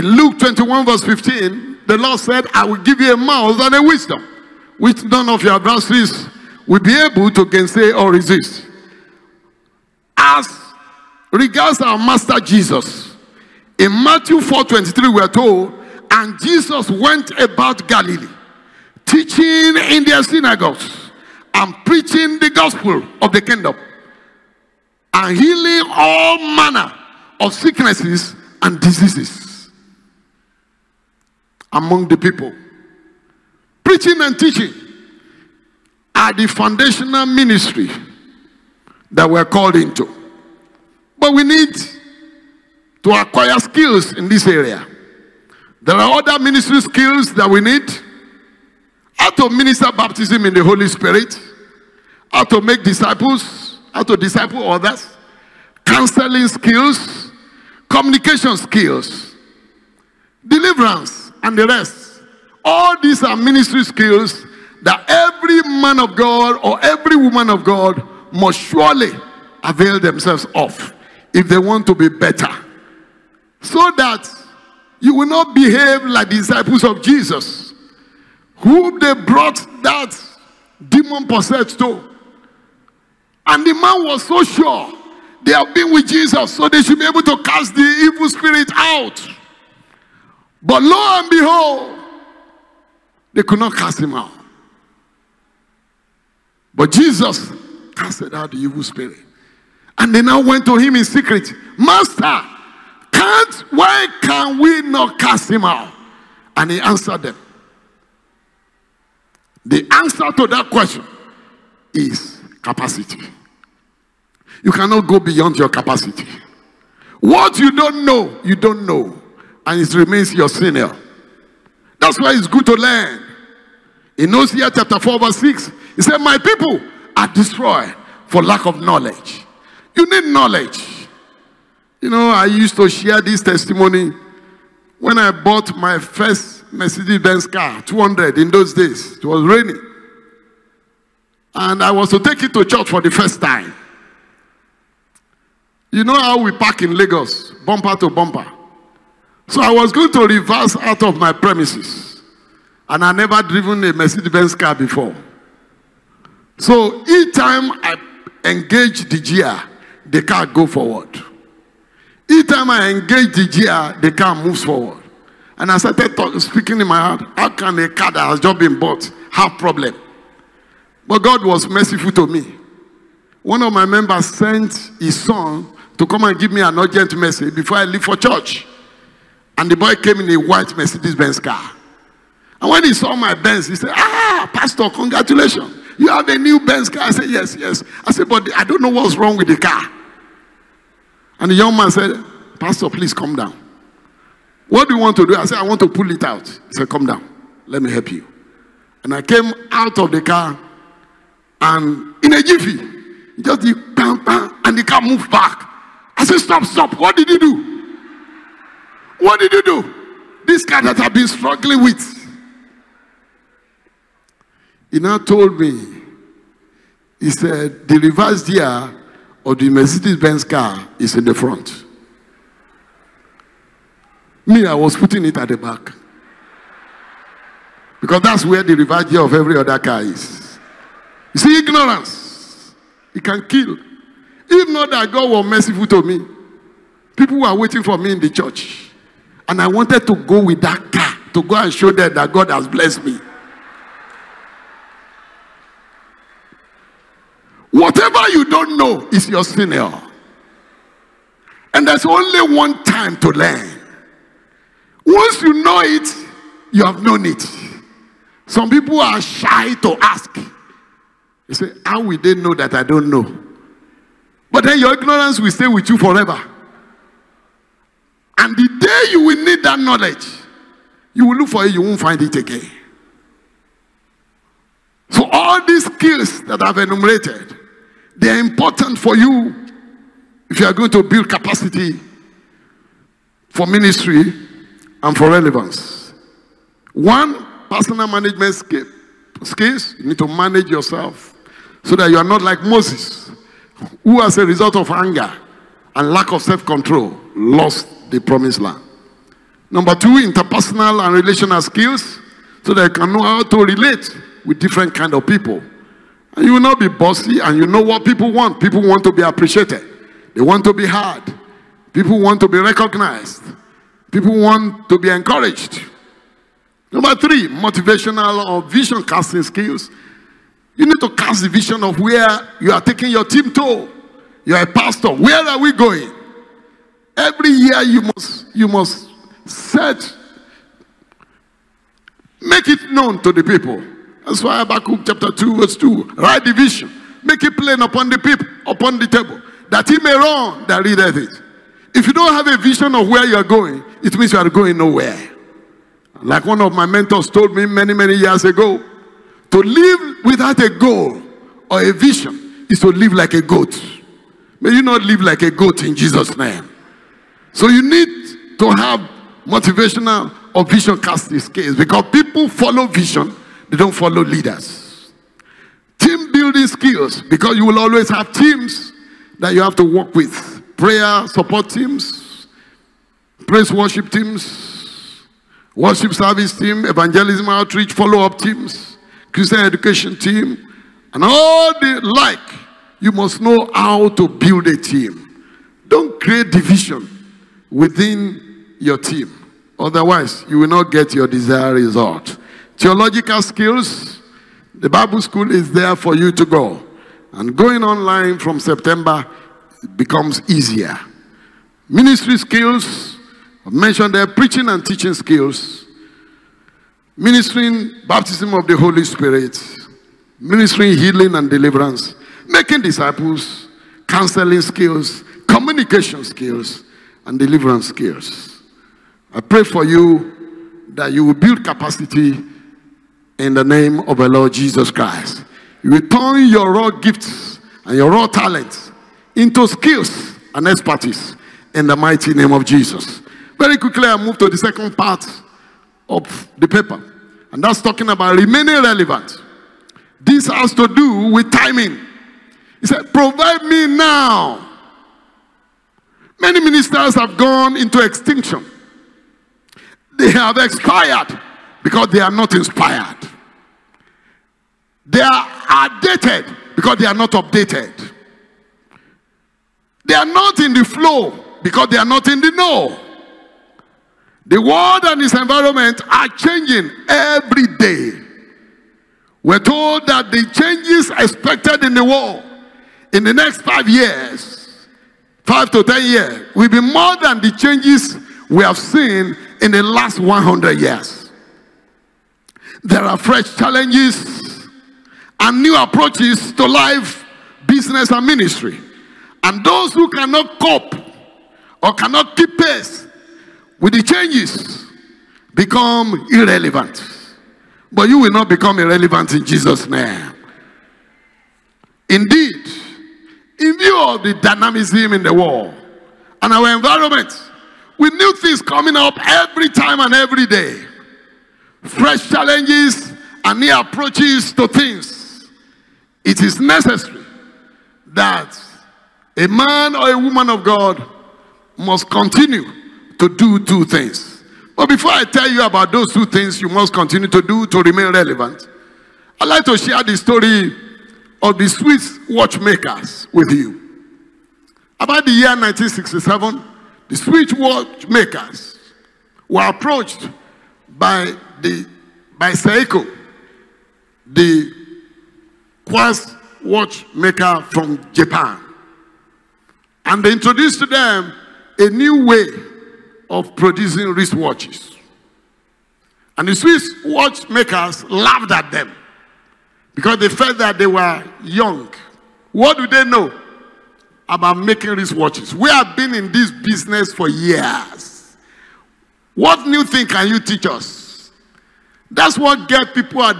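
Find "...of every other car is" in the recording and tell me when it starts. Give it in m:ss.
3:49.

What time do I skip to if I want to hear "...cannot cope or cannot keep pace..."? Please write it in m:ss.
8:10.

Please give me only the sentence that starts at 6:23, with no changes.
You must know how to build a team.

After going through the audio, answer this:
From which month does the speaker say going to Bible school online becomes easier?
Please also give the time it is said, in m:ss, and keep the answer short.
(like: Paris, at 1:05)
September, at 6:38.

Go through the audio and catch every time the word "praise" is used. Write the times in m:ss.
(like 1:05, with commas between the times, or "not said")
6:13.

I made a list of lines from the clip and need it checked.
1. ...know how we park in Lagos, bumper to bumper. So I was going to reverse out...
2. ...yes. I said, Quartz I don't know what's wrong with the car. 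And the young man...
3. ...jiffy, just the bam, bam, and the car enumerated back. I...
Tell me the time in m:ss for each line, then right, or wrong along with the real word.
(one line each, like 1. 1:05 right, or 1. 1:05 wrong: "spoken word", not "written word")
1. 2:26 right
2. 3:07 wrong: "But", not "Quartz"
3. 3:22 wrong: "moved", not "enumerated".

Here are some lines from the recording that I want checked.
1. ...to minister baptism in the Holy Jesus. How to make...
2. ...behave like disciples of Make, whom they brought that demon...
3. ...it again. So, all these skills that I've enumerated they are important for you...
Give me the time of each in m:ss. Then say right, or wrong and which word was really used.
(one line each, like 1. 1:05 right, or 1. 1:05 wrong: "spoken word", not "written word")
1. 0:49 wrong: "Spirit", not "Jesus"
2. 1:15 wrong: "Jesus", not "Make"
3. 4:32 right.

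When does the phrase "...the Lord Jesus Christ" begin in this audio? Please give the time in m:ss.
7:04.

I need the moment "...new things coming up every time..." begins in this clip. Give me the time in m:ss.
8:28.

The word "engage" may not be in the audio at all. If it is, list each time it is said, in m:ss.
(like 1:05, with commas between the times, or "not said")
2:38, 2:42.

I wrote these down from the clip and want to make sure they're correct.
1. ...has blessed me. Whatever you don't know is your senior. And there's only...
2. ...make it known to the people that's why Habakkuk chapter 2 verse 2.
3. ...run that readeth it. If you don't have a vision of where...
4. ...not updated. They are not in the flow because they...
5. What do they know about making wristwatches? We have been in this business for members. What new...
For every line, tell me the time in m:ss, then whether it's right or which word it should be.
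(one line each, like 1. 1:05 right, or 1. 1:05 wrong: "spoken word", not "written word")
1. 4:02 right
2. 5:32 right
3. 5:40 right
4. 7:37 right
5. 9:22 wrong: "years", not "members".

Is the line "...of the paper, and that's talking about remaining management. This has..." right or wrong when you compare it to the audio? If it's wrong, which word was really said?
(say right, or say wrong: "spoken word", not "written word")
wrong: "relevant", not "management".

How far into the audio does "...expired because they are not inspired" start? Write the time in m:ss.
7:30.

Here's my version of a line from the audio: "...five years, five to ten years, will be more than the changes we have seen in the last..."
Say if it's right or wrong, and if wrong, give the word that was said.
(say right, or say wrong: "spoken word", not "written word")
right.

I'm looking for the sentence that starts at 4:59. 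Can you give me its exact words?
Number two, interpersonal and relational skills so that you can know how to relate with different kind of people.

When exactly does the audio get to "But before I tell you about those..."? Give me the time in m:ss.
8:44.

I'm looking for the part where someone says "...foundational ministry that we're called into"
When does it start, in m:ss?
0:36.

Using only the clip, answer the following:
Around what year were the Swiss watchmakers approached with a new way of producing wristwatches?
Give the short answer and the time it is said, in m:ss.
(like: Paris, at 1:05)
1967, at 8:55.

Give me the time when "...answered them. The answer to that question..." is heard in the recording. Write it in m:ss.
1:46.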